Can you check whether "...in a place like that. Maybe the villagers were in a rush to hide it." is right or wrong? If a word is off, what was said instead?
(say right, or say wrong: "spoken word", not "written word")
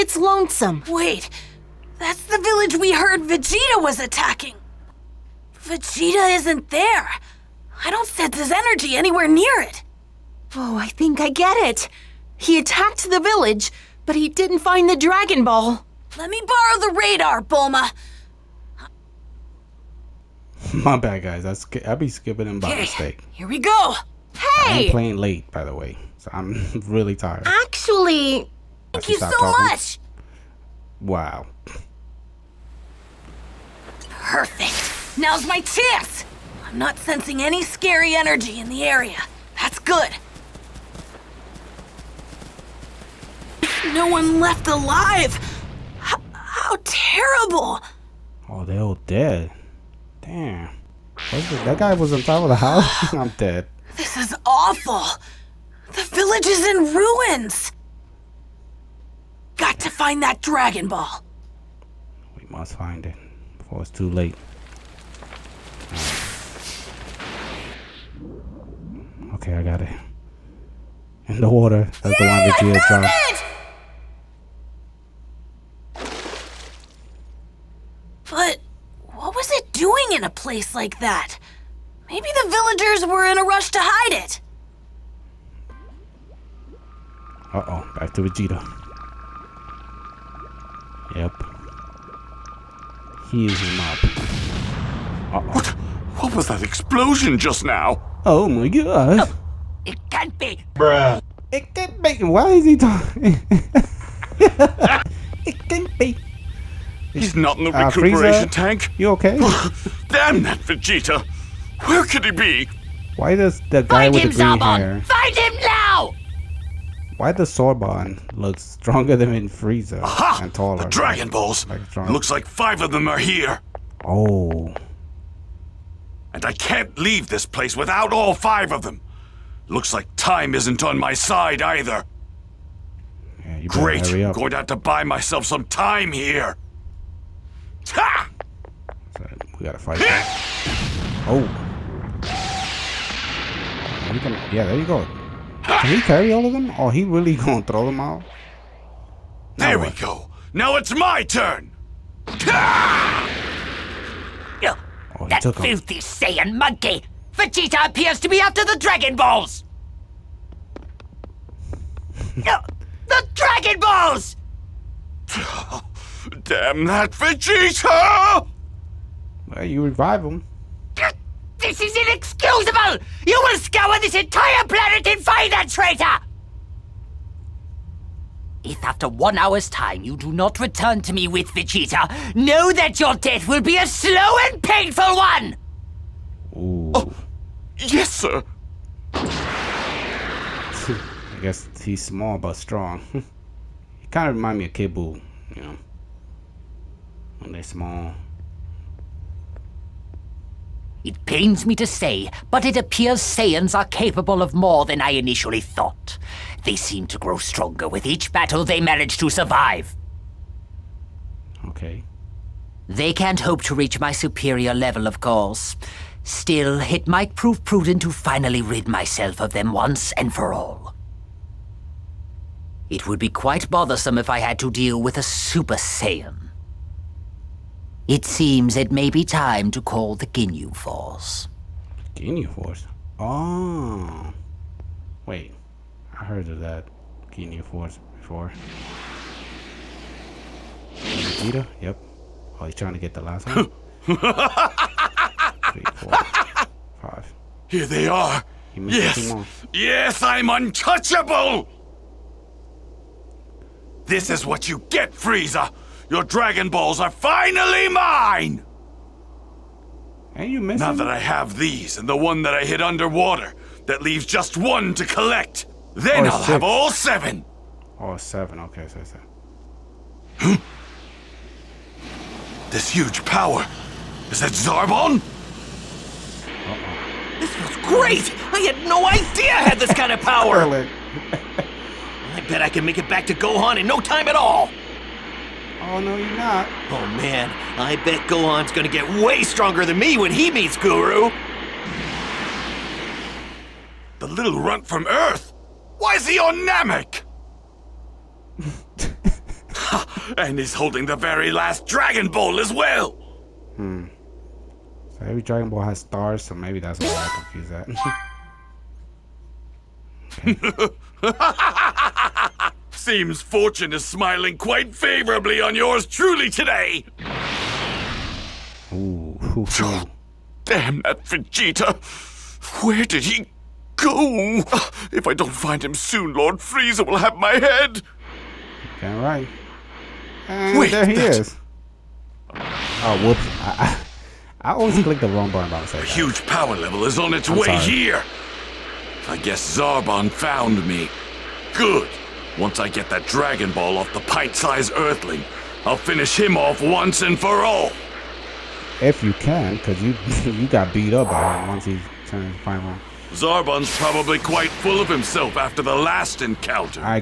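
right.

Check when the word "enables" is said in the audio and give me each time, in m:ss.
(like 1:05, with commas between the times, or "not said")
not said.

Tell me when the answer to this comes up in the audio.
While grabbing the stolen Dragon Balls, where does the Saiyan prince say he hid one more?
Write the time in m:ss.
4:22.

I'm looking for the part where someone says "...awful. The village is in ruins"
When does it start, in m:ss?
0:54.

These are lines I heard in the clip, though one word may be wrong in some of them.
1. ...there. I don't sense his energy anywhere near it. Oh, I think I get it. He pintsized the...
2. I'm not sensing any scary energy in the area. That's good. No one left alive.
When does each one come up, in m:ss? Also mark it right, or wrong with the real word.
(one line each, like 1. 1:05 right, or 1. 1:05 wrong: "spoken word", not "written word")
1. 0:06 wrong: "attacked", not "pintsized"
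2. 0:36 right.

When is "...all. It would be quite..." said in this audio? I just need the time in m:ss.
3:40.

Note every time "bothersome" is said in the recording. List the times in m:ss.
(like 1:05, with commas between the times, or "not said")
3:43.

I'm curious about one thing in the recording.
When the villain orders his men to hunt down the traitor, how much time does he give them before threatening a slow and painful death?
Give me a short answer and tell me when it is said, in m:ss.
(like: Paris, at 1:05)
1 hour, at 2:59.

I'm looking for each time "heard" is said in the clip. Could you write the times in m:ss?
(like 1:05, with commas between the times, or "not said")
0:02, 3:56.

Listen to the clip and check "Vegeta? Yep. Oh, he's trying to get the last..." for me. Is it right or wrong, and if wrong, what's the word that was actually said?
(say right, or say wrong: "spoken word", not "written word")
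right.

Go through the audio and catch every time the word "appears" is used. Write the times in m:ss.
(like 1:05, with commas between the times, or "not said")
2:37, 3:22.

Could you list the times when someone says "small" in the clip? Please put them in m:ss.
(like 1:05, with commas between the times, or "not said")
3:12, 3:17.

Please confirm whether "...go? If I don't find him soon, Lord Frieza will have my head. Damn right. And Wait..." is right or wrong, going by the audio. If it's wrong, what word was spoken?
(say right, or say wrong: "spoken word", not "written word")
right.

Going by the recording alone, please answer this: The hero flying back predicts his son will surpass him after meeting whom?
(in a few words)
Guru.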